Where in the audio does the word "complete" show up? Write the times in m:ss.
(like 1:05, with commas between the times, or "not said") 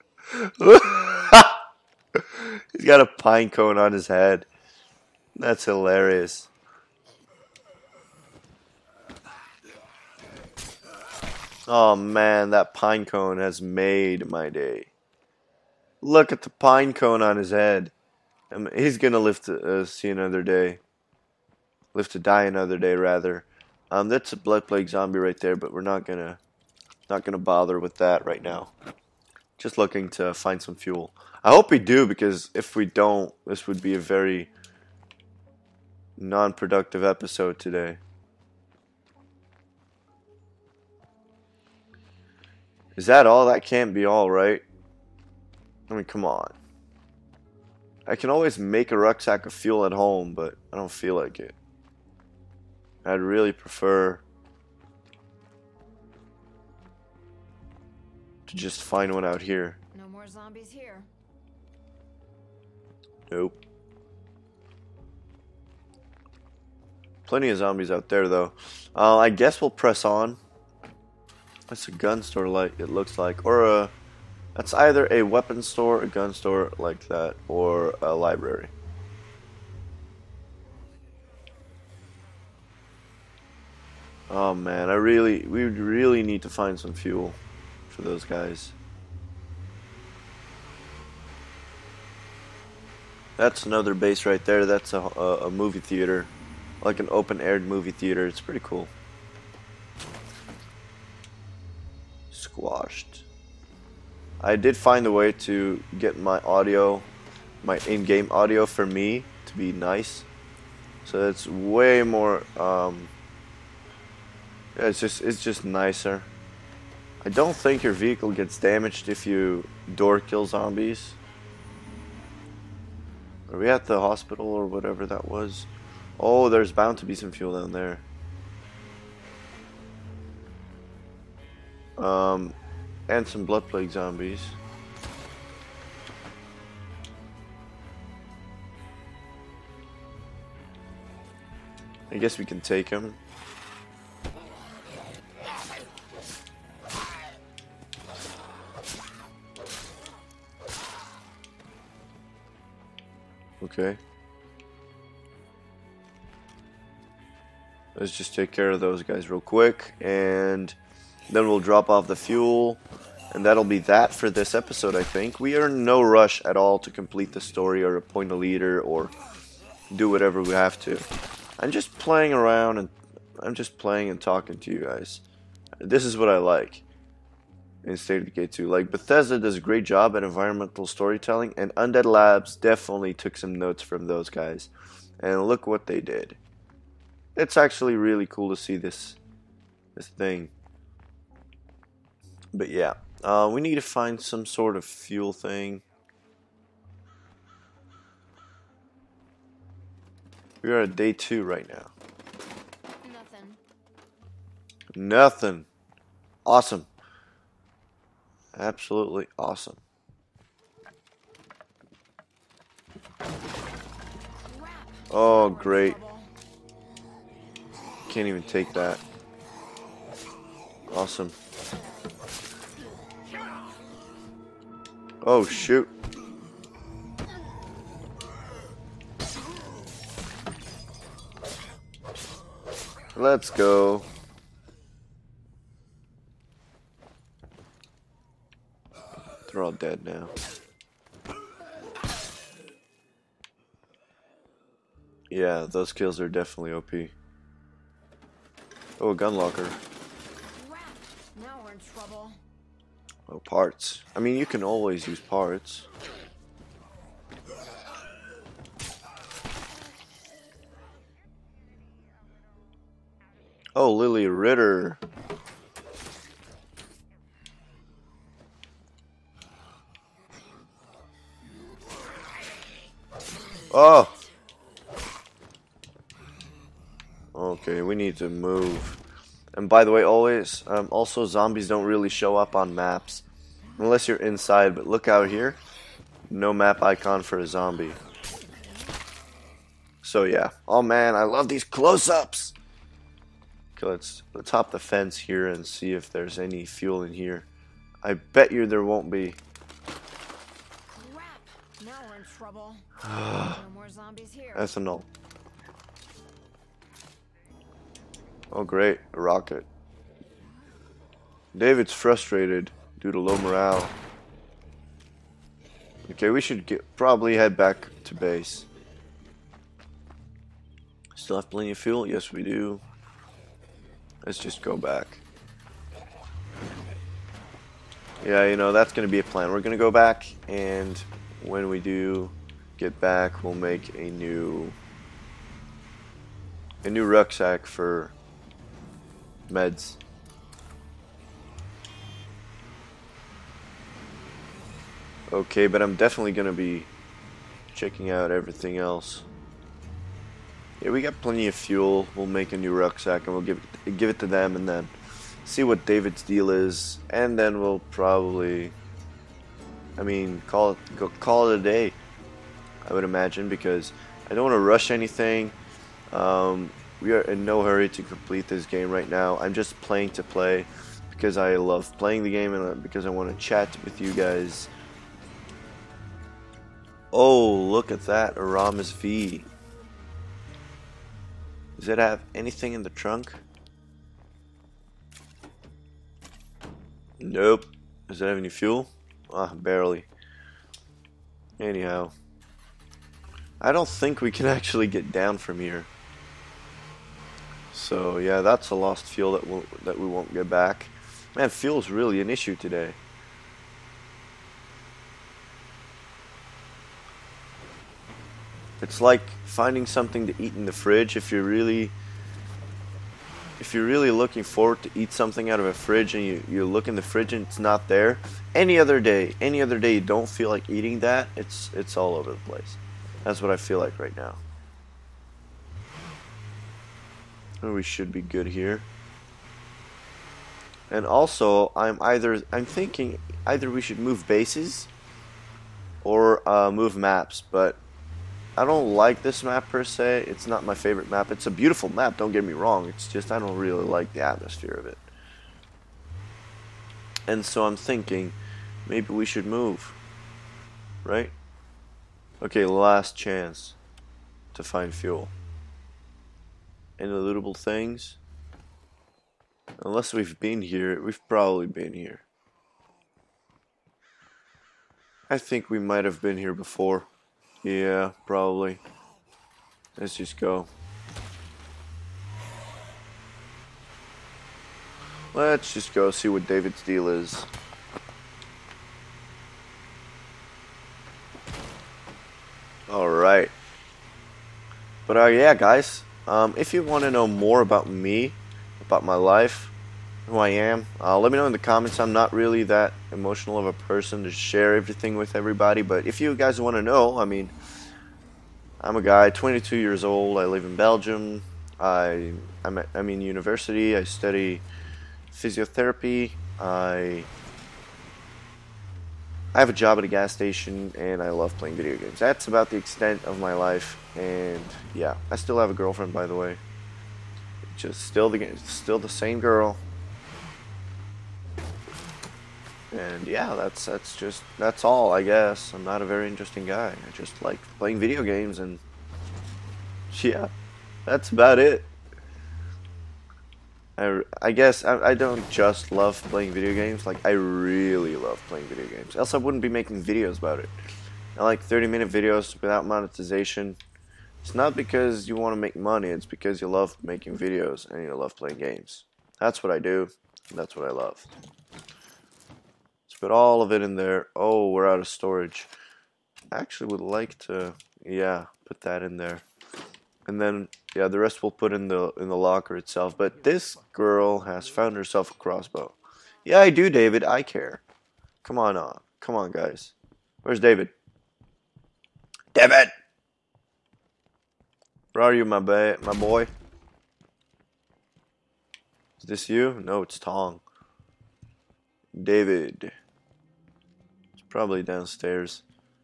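2:46, 6:08.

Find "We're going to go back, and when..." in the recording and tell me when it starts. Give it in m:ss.
5:29.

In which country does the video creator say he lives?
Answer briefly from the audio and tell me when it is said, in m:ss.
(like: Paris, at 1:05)
Belgium, at 8:20.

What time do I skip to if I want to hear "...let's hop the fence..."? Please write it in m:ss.
4:54.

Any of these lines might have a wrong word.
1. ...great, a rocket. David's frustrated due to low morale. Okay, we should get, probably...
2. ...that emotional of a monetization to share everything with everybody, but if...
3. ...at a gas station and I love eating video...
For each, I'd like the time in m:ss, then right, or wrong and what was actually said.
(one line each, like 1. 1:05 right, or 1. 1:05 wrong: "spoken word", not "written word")
1. 5:08 right
2. 8:12 wrong: "person", not "monetization"
3. 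8:29 wrong: "playing", not "eating".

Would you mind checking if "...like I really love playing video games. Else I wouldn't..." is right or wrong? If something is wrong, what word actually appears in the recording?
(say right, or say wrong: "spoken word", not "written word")
right.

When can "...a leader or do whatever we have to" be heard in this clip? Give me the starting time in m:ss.
2:48.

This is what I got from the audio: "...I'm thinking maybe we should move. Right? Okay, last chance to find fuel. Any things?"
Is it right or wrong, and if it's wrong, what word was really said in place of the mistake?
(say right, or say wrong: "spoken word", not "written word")
right.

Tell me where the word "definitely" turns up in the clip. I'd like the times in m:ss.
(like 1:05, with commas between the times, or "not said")
3:02, 4:06, 5:45.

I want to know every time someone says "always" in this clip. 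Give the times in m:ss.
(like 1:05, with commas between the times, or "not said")
0:48, 4:14, 4:40.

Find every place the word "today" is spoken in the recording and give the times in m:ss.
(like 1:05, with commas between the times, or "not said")
0:37, 6:42.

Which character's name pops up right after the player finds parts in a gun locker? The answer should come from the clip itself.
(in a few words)
Lily Ritter.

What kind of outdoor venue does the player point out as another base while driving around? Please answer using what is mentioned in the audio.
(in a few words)
Open-aired movie theater.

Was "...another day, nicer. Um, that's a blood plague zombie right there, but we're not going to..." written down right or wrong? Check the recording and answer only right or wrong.
wrong.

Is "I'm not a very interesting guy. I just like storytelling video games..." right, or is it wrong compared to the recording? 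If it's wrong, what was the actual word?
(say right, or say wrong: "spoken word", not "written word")
wrong: "playing", not "storytelling".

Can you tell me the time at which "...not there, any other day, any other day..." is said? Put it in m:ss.
6:57.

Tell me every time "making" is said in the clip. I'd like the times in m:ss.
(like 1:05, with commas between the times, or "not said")
8:59, 9:07.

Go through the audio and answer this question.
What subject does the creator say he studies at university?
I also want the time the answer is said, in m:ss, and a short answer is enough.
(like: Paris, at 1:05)
Physiotherapy, at 8:25.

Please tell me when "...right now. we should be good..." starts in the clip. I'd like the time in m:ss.
7:03.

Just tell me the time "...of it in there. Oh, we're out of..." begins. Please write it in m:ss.
9:13.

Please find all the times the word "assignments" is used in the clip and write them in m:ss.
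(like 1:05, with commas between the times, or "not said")
not said.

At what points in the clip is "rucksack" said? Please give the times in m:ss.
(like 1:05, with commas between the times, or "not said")
0:48, 5:37, 5:52.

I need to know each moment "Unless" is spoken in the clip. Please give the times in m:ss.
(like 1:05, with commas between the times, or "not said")
4:43, 7:39.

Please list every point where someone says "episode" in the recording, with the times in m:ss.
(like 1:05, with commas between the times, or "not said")
0:37, 2:44.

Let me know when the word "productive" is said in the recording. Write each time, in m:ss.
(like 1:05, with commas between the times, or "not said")
0:36.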